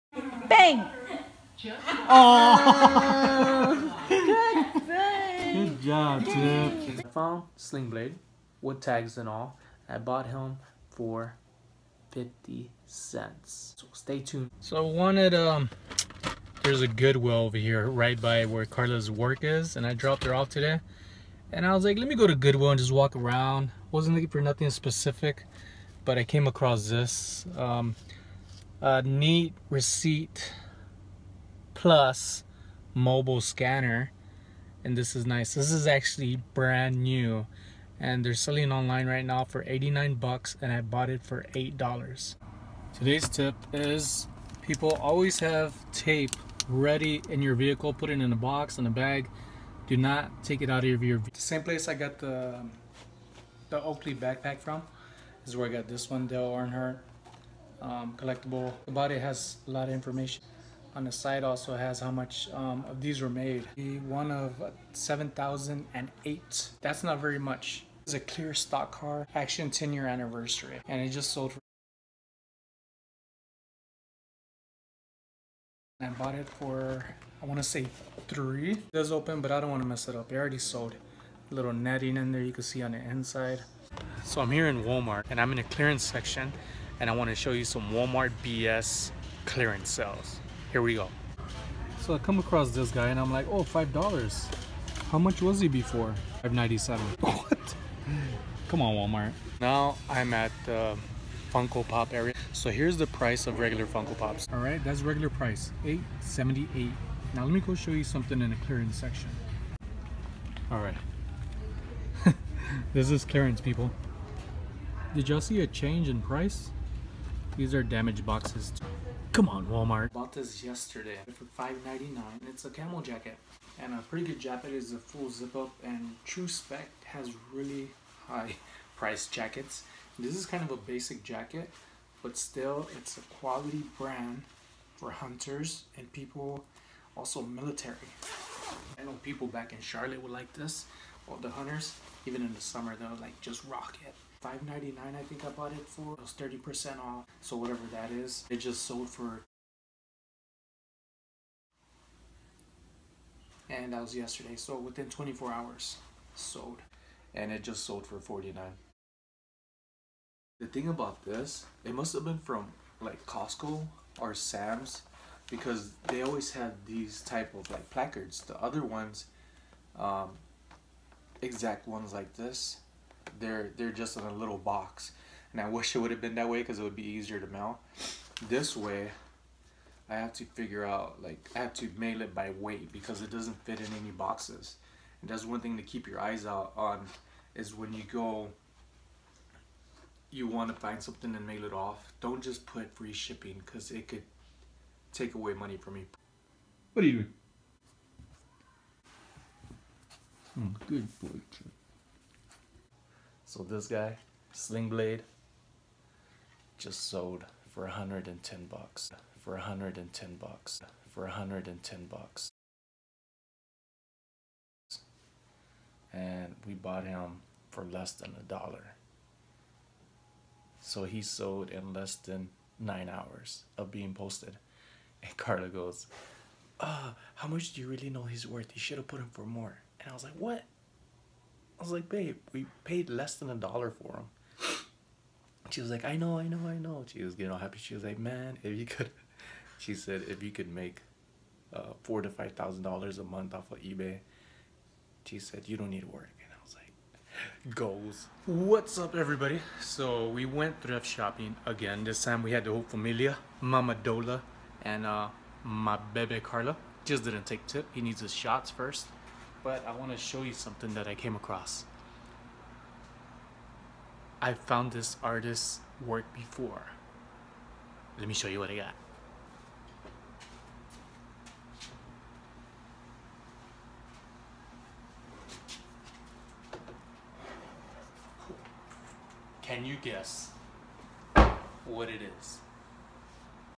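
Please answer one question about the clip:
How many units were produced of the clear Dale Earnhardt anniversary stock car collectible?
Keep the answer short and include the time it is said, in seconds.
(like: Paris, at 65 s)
7,008, at 64 s.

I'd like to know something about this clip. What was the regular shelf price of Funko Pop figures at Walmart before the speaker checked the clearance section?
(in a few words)
$8.78.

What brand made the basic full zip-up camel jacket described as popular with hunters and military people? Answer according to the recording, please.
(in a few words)
Tru-Spec.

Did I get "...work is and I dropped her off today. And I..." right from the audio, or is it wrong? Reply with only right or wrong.
right.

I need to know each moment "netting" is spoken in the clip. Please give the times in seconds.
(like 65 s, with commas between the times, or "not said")
81 s.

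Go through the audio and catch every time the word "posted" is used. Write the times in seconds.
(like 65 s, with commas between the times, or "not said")
224 s.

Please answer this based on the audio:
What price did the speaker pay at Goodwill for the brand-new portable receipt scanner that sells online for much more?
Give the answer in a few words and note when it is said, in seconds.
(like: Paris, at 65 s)
$8, at 41 s.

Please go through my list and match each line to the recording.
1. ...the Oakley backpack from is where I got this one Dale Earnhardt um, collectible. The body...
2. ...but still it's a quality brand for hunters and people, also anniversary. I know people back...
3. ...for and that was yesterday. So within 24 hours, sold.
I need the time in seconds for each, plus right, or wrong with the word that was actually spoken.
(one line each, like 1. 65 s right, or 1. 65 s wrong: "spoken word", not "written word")
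1. 53 s right
2. 132 s wrong: "military", not "anniversary"
3. 149 s right.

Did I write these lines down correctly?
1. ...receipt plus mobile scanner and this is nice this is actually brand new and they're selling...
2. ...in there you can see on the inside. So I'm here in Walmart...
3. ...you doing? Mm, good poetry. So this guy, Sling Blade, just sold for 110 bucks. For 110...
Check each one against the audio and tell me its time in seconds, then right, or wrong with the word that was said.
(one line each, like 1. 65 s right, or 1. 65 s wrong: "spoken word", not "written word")
1. 29 s right
2. 82 s right
3. 197 s right.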